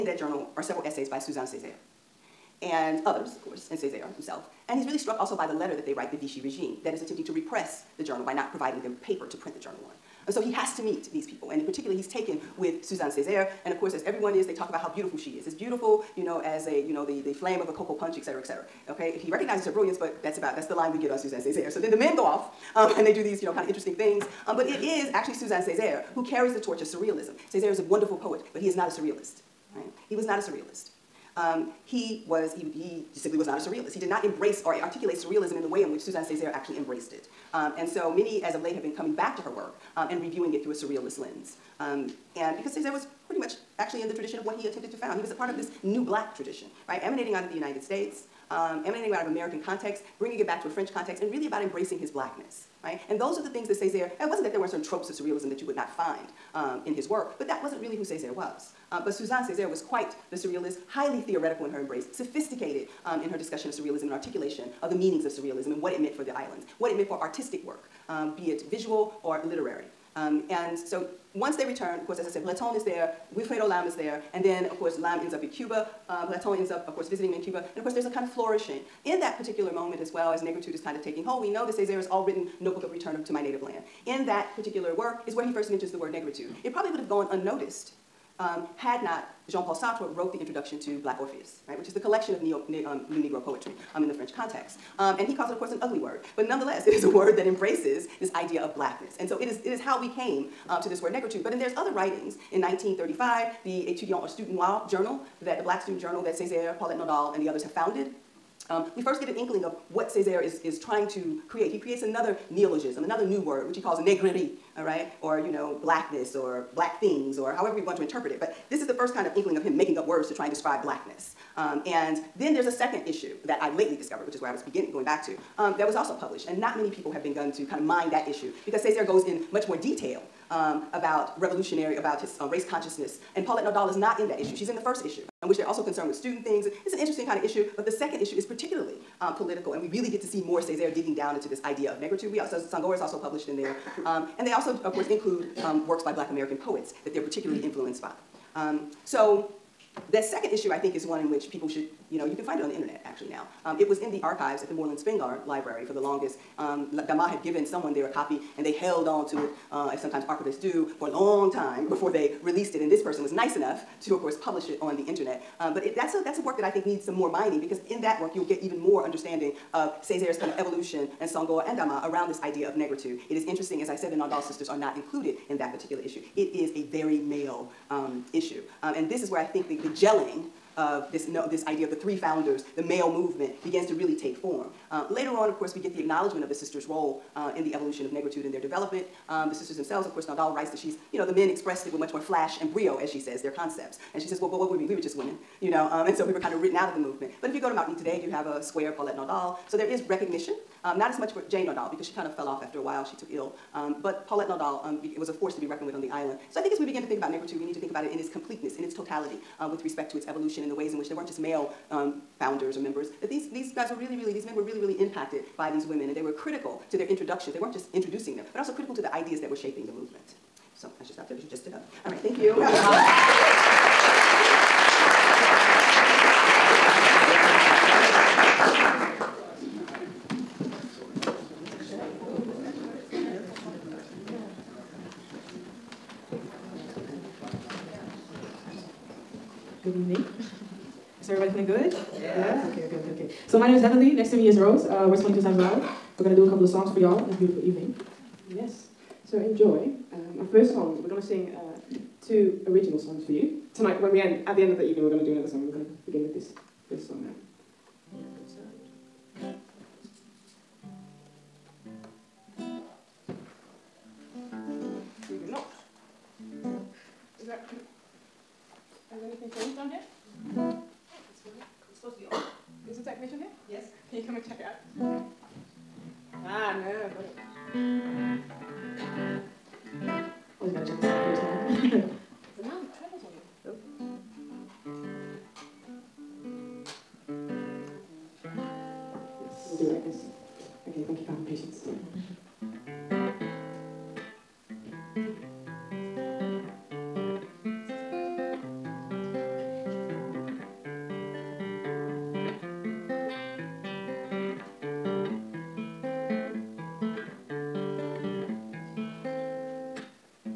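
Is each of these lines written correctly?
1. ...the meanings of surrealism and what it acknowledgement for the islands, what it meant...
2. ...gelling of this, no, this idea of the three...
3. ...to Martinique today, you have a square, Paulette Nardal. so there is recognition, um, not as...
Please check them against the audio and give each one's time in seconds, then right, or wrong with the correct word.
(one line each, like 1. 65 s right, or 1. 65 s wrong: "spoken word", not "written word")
1. 64 s wrong: "meant", not "acknowledgement"
2. 179 s right
3. 197 s right.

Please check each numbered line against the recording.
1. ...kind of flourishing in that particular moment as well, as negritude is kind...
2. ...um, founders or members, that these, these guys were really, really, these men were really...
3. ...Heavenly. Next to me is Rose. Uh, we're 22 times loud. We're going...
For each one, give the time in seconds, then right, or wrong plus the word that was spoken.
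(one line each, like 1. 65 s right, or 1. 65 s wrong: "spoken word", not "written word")
1. 78 s right
2. 211 s right
3. 243 s right.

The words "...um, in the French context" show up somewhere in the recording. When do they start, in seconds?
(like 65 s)
93 s.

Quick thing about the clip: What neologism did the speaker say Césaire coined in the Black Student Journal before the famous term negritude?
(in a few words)
negrerie.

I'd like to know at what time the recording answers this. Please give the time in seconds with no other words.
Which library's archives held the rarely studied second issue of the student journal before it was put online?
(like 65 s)
154 s.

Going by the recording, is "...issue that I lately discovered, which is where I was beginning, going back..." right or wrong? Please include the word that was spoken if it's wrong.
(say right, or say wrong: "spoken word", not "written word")
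right.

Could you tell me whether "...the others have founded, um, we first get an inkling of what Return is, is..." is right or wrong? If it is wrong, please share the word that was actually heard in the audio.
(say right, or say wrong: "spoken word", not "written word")
wrong: "Césaire", not "Return".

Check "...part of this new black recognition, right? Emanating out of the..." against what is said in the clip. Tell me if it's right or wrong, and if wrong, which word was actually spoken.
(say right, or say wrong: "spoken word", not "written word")
wrong: "tradition", not "recognition".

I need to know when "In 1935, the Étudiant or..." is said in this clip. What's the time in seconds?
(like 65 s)
102 s.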